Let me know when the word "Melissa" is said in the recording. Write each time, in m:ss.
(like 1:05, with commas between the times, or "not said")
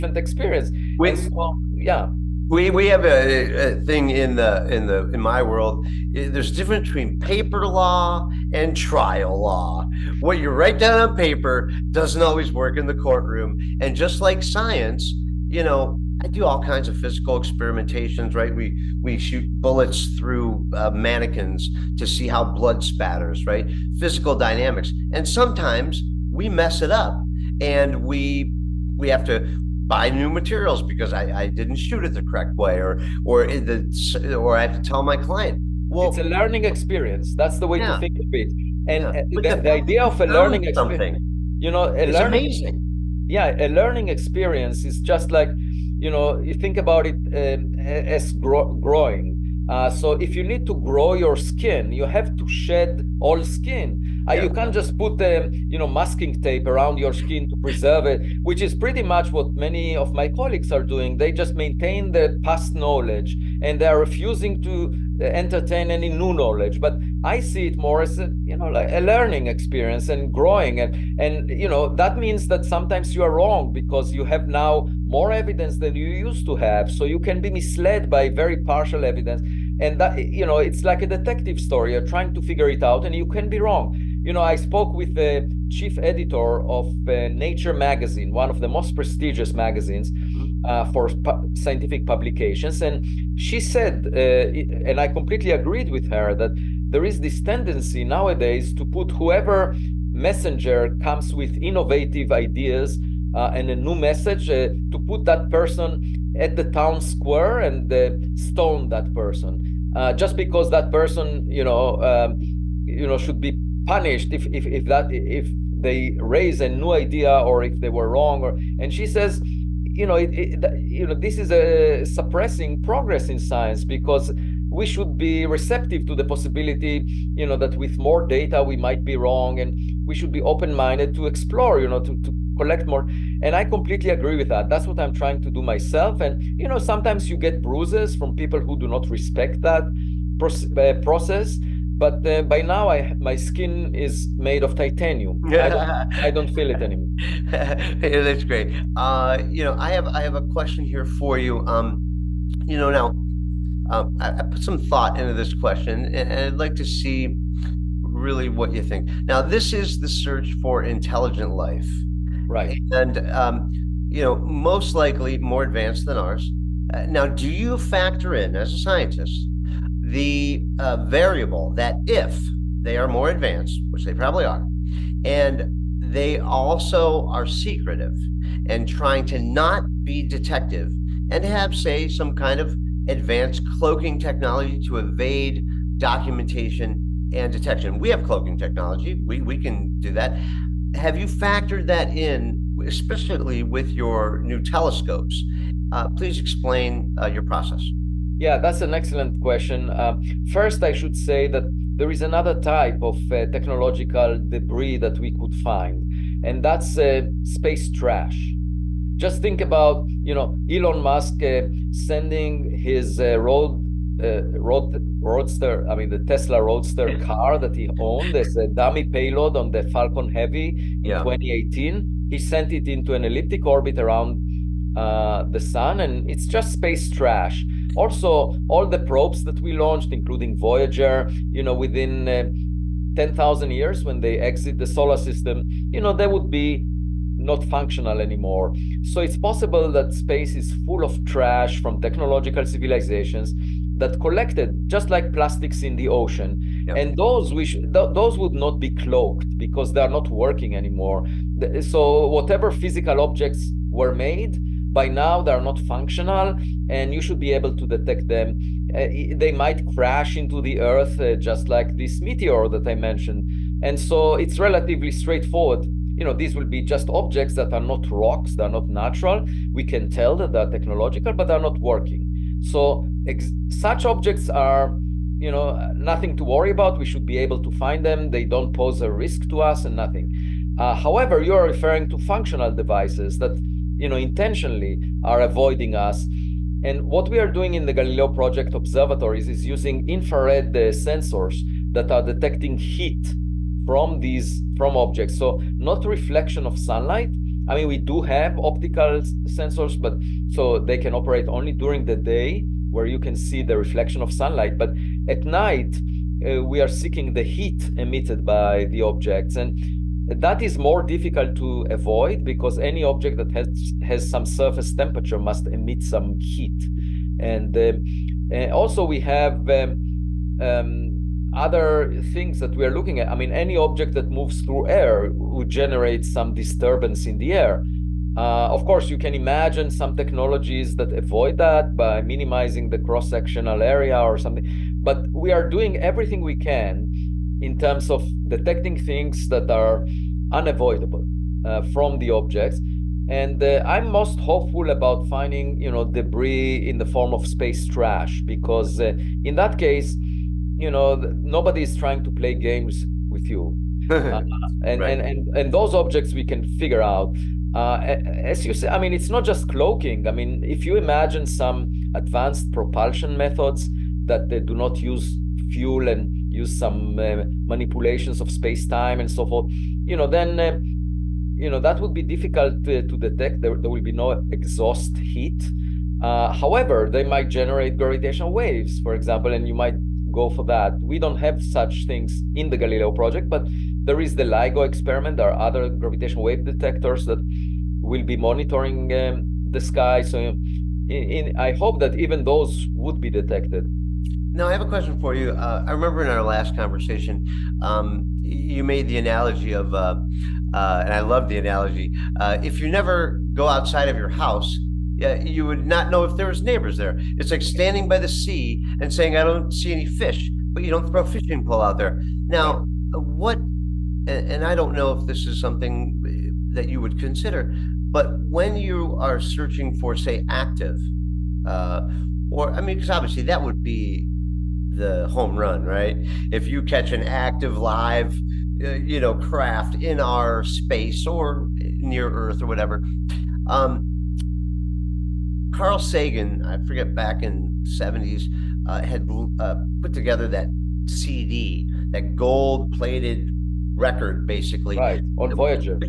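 not said.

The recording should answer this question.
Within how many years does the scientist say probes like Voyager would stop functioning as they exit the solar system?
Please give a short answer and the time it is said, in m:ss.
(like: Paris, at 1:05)
10,000, at 3:53.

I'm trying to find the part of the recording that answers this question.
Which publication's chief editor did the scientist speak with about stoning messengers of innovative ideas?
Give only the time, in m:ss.
1:27.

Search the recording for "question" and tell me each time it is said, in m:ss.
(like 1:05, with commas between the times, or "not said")
2:30, 2:35, 3:19, 6:34.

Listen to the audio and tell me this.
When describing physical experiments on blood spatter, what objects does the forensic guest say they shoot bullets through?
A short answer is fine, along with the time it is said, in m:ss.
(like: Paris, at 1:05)
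mannequins, at 0:20.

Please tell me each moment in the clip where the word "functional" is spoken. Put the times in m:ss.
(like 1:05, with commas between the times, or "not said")
3:57, 4:15, 4:42.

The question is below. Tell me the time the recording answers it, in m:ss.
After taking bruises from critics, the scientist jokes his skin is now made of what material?
2:24.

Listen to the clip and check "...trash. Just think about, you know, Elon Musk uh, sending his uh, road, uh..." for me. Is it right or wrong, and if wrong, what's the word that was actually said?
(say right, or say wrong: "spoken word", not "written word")
right.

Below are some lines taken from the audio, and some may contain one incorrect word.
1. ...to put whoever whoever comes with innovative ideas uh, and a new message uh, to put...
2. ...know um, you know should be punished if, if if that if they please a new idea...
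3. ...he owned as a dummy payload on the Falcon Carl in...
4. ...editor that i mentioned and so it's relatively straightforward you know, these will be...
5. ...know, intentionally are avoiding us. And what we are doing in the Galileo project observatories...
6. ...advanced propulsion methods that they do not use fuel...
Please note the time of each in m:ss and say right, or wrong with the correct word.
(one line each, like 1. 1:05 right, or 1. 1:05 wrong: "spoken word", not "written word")
1. 1:38 wrong: "messenger", not "whoever"
2. 1:51 wrong: "raise", not "please"
3. 3:37 wrong: "Heavy", not "Carl"
4. 4:22 wrong: "meteor", not "editor"
5. 4:44 right
6. 6:02 right.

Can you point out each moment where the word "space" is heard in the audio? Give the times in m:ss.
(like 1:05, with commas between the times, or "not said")
3:27, 3:46, 4:00, 5:47, 6:08, 7:10.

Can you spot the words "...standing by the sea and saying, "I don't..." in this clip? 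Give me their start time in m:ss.
6:47.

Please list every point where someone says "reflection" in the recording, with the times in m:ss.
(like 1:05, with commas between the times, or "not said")
4:56, 5:03.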